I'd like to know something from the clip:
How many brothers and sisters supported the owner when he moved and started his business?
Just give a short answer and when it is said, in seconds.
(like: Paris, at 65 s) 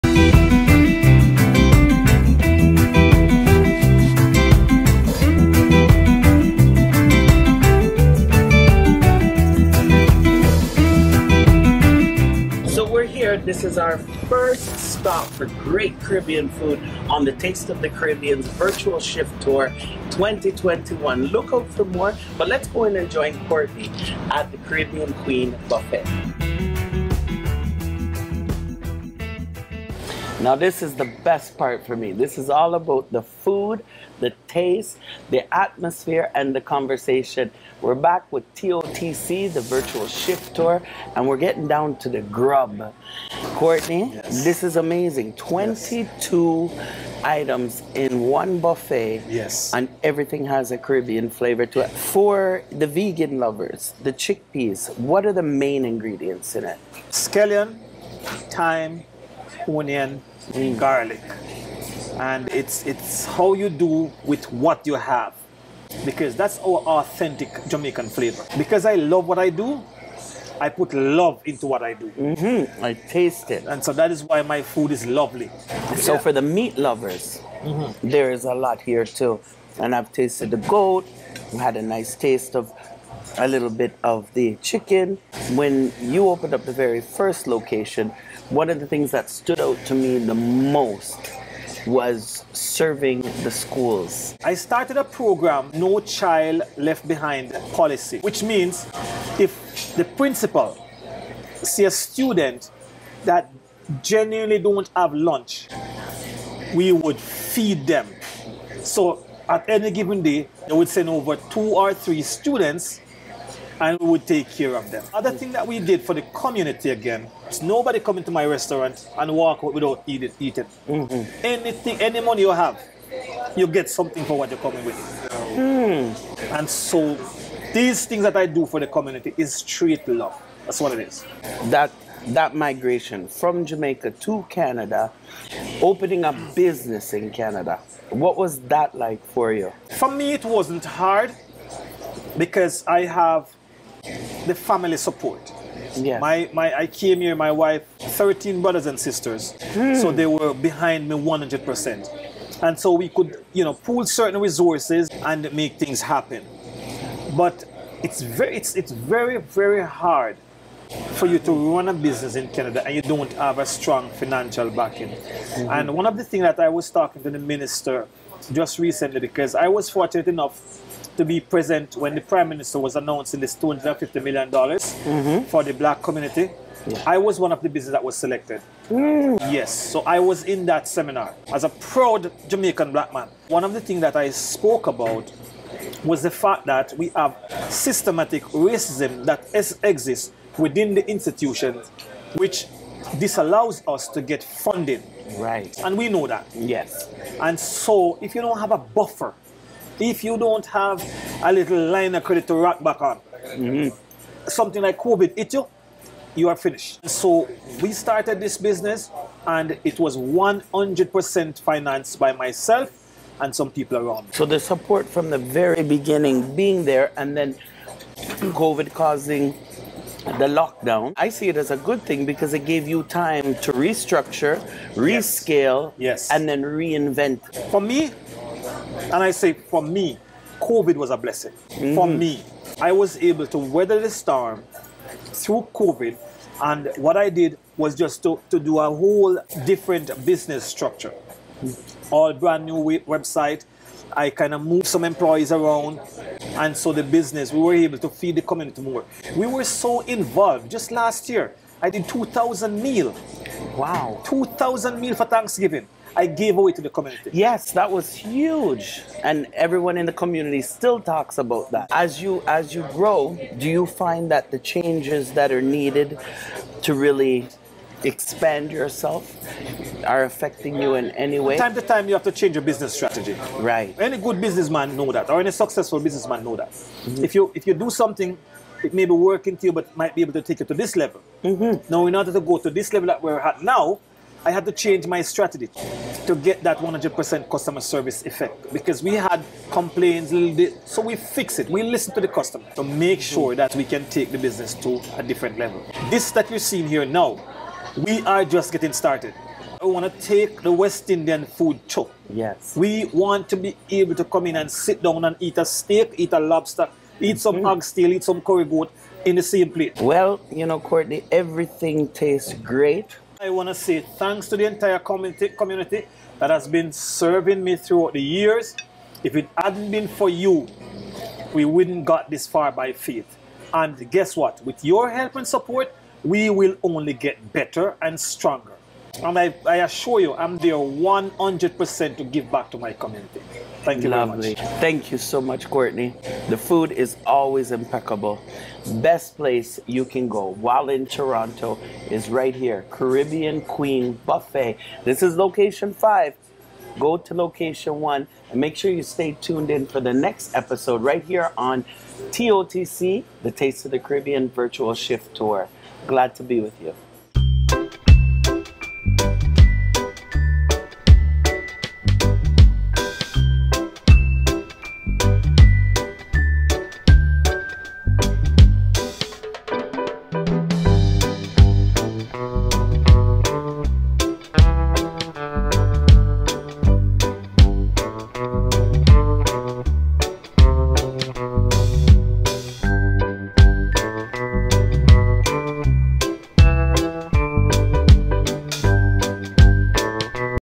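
13, at 147 s.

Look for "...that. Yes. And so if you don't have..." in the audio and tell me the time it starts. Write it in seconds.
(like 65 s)
196 s.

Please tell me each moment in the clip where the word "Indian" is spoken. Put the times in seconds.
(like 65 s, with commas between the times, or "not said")
301 s.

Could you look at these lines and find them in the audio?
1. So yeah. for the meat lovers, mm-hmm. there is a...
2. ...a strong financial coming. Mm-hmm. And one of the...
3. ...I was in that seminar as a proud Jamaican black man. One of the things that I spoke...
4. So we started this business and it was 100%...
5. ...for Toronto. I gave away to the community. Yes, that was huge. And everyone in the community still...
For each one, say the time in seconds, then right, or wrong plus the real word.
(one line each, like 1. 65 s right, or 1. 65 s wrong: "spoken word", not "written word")
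1. 75 s right
2. 163 s wrong: "backing", not "coming"
3. 180 s right
4. 207 s right
5. 255 s wrong: "Thanksgiving", not "Toronto".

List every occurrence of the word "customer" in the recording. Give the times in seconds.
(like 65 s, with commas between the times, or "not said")
287 s, 292 s.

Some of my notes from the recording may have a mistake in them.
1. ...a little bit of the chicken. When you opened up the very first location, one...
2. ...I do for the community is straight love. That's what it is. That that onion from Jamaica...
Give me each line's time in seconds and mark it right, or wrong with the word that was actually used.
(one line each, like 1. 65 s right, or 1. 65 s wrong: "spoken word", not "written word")
1. 83 s right
2. 128 s wrong: "migration", not "onion".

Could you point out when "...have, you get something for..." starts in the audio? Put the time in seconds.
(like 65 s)
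122 s.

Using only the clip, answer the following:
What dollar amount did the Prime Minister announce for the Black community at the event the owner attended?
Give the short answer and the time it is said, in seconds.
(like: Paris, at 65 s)
$250 million, at 173 s.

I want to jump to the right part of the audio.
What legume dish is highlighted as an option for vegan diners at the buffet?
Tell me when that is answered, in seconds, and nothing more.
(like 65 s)
54 s.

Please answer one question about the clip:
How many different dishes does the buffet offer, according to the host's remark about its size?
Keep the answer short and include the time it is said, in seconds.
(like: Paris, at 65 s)
22, at 45 s.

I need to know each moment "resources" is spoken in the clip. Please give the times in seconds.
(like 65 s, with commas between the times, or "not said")
154 s.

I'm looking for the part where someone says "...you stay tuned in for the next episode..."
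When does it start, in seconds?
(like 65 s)
348 s.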